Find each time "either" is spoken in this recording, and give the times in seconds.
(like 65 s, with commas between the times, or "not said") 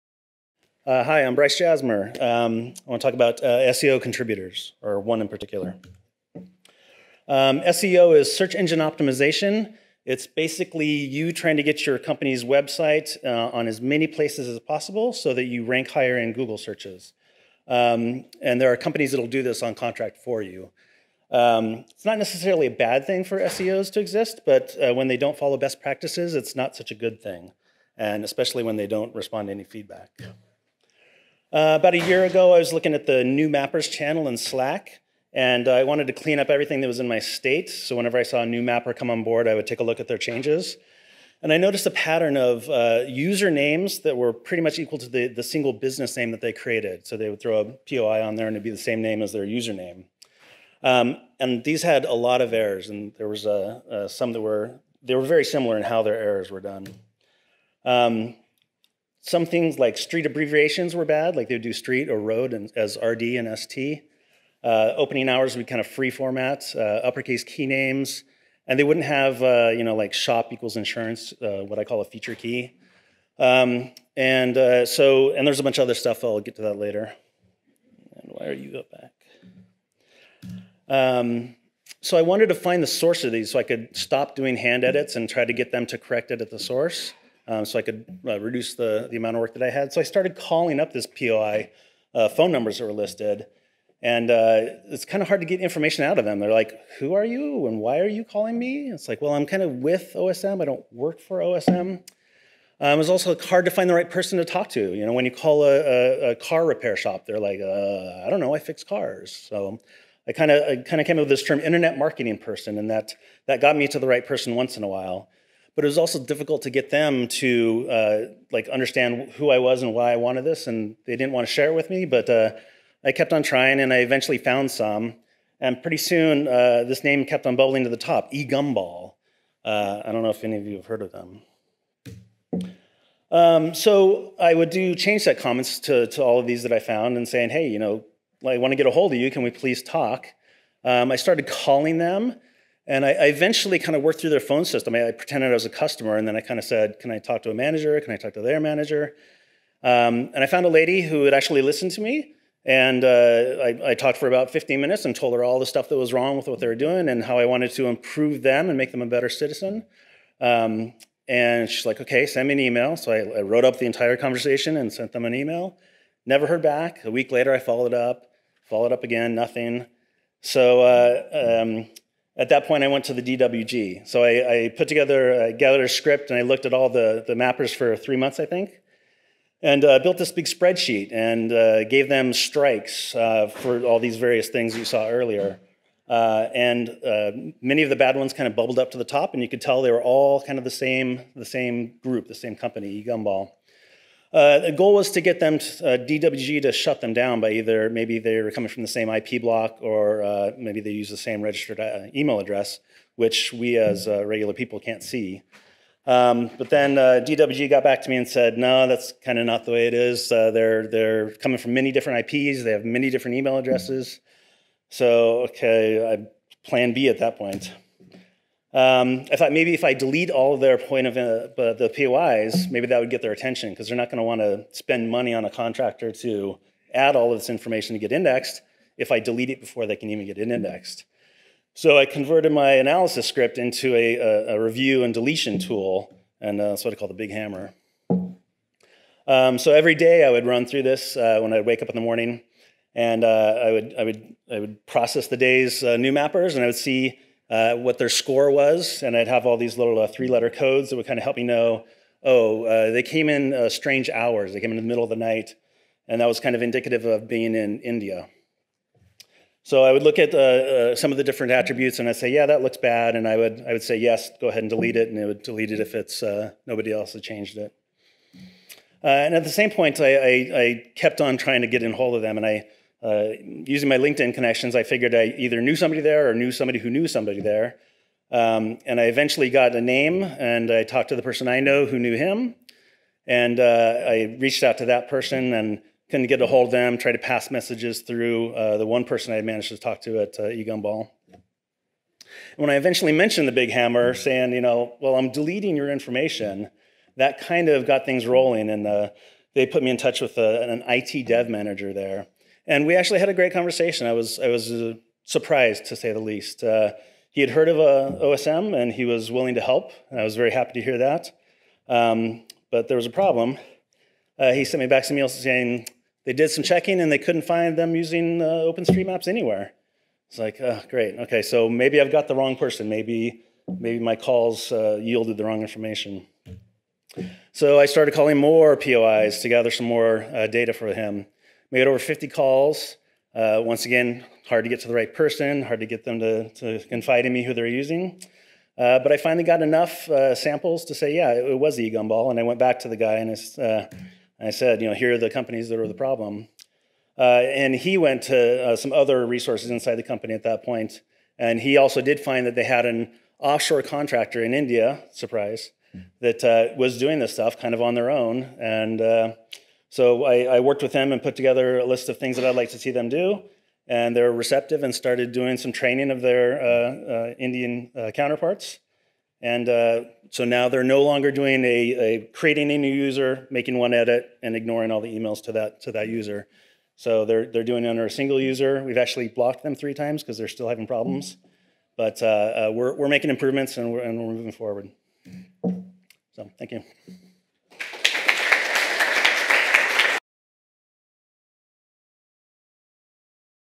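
197 s, 275 s.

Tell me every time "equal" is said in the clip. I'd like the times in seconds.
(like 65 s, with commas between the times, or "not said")
44 s, 70 s.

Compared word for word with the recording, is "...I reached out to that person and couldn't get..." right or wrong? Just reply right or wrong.
right.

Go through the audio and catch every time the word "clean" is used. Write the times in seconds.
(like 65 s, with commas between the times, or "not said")
36 s.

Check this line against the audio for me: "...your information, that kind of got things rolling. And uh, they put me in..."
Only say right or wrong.
right.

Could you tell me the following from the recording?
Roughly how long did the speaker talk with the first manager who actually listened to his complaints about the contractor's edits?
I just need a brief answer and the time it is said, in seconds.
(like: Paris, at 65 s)
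15 minutes, at 154 s.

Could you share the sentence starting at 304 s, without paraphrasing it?
I was I was uh, surprised to say the least.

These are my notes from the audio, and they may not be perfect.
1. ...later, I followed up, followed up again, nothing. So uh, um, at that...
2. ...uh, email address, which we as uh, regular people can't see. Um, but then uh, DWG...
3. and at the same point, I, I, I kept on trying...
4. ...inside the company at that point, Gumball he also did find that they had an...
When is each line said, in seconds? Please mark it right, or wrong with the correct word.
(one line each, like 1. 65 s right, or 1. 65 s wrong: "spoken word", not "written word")
1. 167 s right
2. 201 s right
3. 269 s right
4. 349 s wrong: "And", not "Gumball".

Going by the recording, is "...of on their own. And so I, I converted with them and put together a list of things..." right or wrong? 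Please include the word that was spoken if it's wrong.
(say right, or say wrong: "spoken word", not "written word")
wrong: "worked", not "converted".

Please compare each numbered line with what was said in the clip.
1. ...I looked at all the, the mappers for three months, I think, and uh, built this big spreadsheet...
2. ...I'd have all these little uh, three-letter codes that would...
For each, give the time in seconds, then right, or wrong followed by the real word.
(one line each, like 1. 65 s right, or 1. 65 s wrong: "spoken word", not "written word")
1. 176 s right
2. 249 s right.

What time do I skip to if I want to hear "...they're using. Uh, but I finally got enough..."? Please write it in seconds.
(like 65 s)
337 s.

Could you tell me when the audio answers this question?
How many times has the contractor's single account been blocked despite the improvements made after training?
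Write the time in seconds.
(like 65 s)
379 s.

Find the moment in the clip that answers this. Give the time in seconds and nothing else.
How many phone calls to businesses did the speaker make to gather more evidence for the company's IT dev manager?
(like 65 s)
331 s.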